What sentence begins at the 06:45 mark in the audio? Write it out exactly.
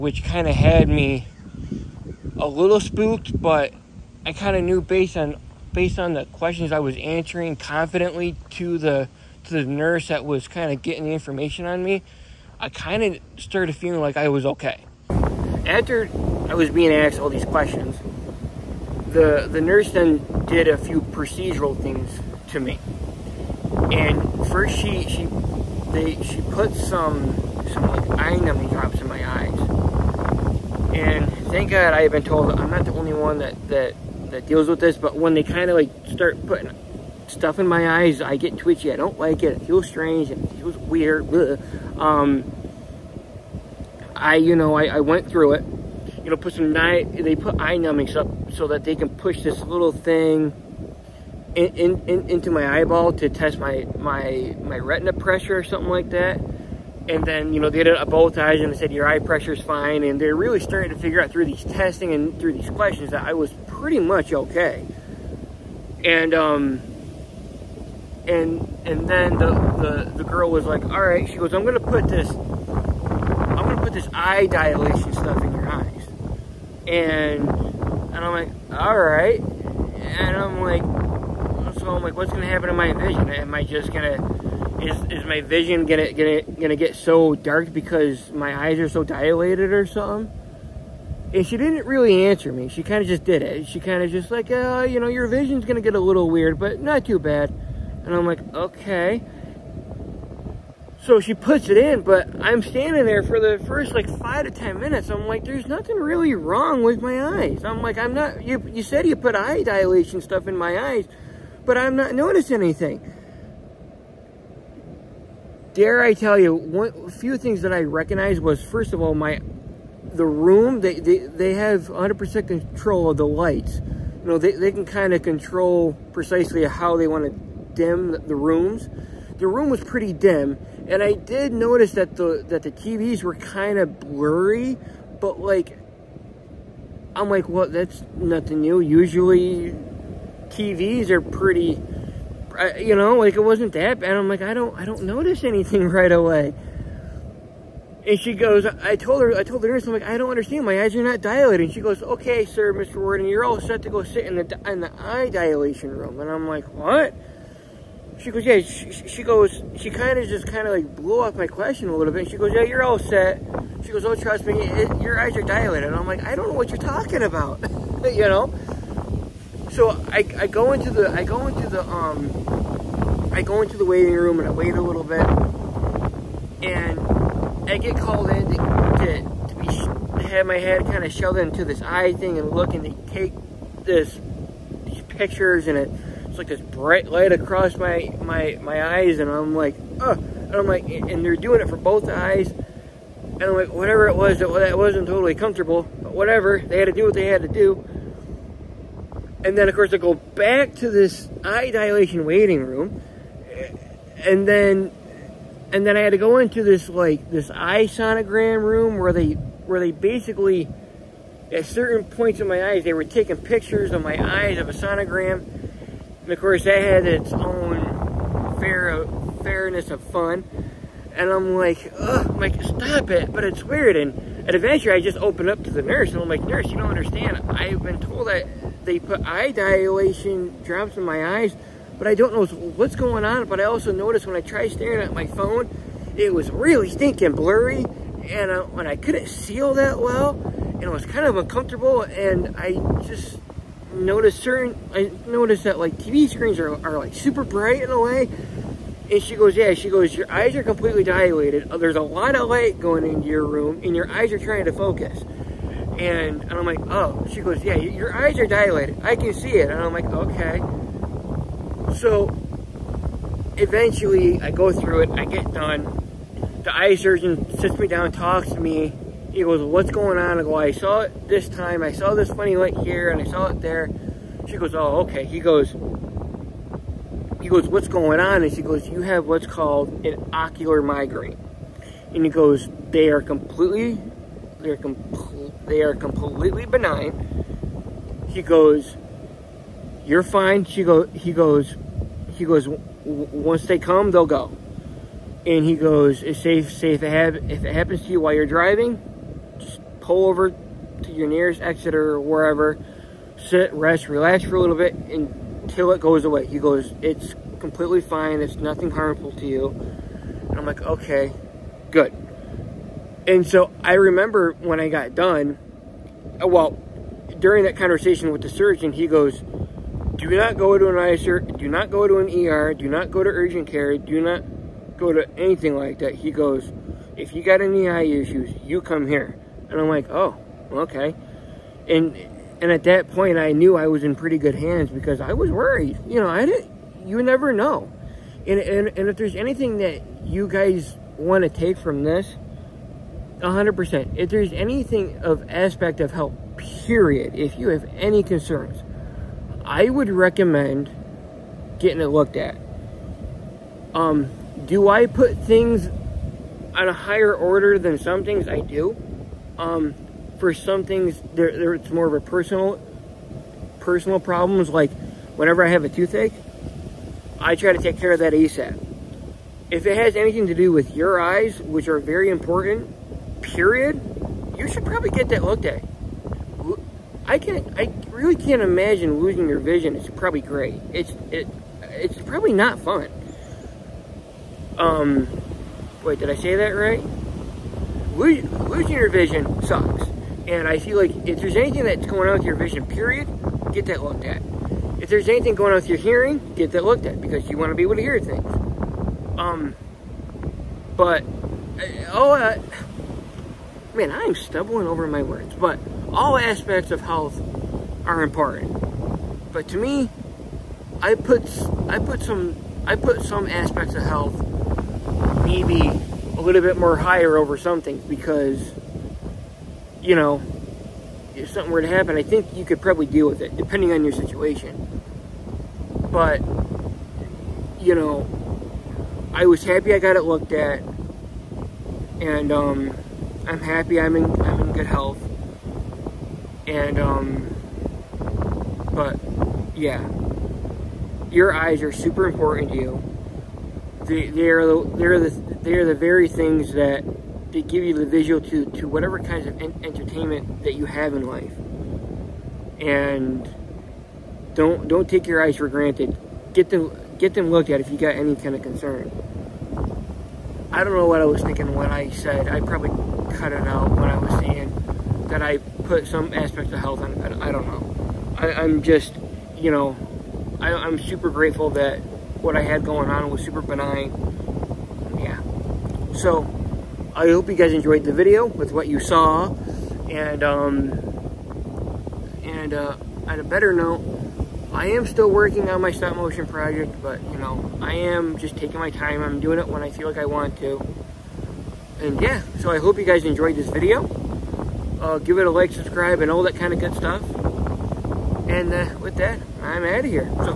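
But all aspects of health are important.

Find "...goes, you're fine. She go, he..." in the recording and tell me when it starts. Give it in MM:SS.
04:48.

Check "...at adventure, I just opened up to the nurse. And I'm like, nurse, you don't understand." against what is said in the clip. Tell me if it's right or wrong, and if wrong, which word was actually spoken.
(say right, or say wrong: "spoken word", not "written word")
right.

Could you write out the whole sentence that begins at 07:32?
And don't don't take your eyes for granted.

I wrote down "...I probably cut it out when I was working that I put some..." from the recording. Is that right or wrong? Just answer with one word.
wrong.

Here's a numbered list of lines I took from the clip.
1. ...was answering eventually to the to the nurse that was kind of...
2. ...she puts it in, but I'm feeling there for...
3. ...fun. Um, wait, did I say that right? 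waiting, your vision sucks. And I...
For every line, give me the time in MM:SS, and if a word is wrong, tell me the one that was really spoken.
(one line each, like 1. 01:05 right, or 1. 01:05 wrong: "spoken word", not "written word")
1. 00:06 wrong: "confidently", not "eventually"
2. 01:41 wrong: "standing", not "feeling"
3. 06:22 wrong: "losing", not "waiting".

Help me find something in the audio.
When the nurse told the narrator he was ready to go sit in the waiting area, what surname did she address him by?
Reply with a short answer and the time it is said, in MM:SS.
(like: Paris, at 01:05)
Worden, at 02:32.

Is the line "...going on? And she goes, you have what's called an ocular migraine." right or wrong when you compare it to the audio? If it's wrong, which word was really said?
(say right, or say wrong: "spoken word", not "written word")
right.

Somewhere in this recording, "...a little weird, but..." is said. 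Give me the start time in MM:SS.
01:35.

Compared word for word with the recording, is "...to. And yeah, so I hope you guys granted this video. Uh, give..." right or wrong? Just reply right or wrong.
wrong.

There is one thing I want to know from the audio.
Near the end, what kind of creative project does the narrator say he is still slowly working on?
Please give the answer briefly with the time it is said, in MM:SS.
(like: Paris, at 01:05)
Stop motion project, at 08:05.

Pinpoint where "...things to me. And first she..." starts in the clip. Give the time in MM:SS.
00:21.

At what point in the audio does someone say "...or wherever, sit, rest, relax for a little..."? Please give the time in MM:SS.
05:01.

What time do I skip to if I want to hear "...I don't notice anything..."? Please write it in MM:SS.
02:24.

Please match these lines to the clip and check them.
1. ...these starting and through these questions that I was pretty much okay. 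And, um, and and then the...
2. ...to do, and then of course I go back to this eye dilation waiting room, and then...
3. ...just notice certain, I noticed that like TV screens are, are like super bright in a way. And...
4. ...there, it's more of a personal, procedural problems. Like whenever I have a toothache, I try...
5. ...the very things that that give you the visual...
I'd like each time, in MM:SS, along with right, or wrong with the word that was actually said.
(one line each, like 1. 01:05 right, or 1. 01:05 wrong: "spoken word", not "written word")
1. 01:01 wrong: "testing", not "starting"
2. 03:17 right
3. 04:03 right
4. 06:01 wrong: "personal", not "procedural"
5. 07:25 right.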